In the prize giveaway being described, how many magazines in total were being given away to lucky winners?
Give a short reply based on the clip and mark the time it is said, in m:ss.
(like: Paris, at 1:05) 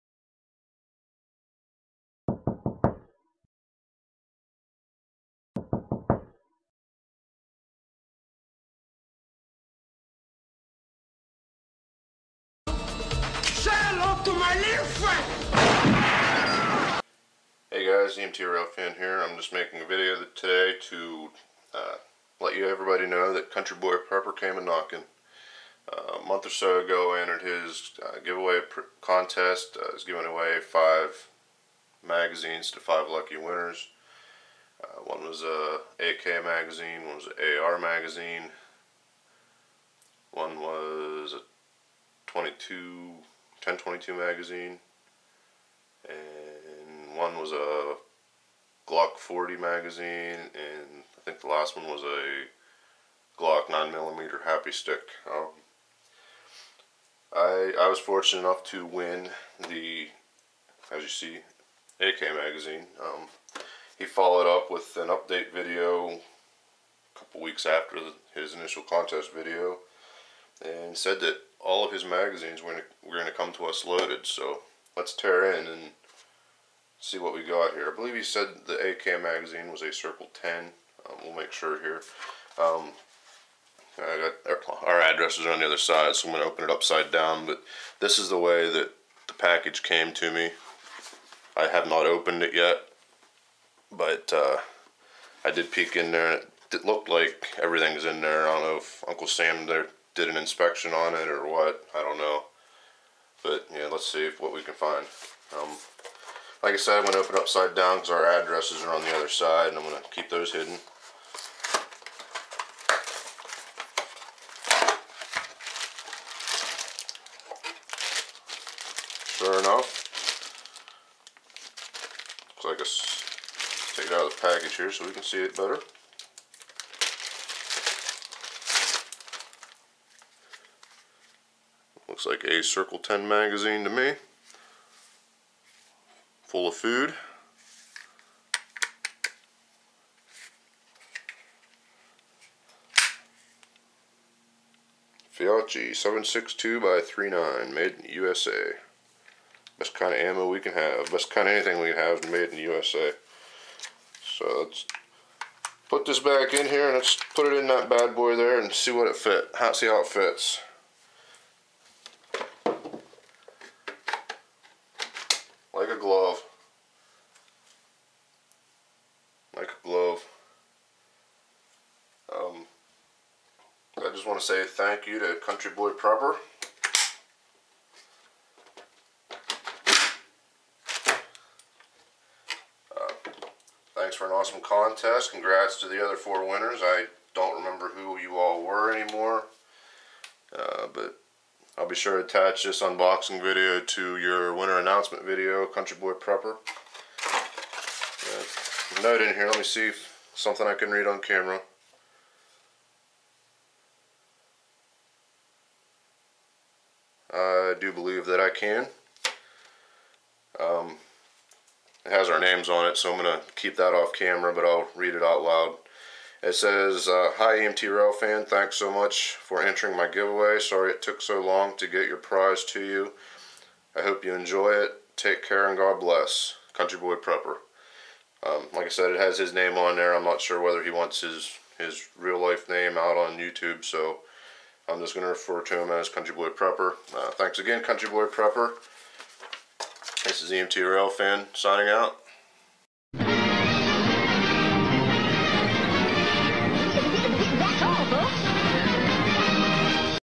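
5, at 0:30.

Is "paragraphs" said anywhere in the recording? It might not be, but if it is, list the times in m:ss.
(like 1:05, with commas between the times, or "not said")
not said.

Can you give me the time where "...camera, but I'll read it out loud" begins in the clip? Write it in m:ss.
3:34.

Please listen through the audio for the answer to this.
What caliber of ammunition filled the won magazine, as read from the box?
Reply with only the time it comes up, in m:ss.
2:25.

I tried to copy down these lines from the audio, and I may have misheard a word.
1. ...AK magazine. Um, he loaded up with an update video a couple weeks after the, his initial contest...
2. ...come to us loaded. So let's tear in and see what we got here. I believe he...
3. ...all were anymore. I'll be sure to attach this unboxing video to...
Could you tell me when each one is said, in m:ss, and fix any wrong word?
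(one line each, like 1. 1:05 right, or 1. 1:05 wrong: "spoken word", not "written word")
1. 1:01 wrong: "followed", not "loaded"
2. 1:13 right
3. 3:08 right.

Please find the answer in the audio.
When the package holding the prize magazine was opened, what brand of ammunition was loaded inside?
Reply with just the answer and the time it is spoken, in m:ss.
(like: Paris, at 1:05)
Fiocchi, at 2:25.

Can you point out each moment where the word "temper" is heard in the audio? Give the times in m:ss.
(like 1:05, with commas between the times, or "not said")
not said.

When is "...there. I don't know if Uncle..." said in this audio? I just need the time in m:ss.
1:38.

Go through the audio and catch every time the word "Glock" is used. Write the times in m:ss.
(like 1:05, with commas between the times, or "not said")
0:48, 0:53.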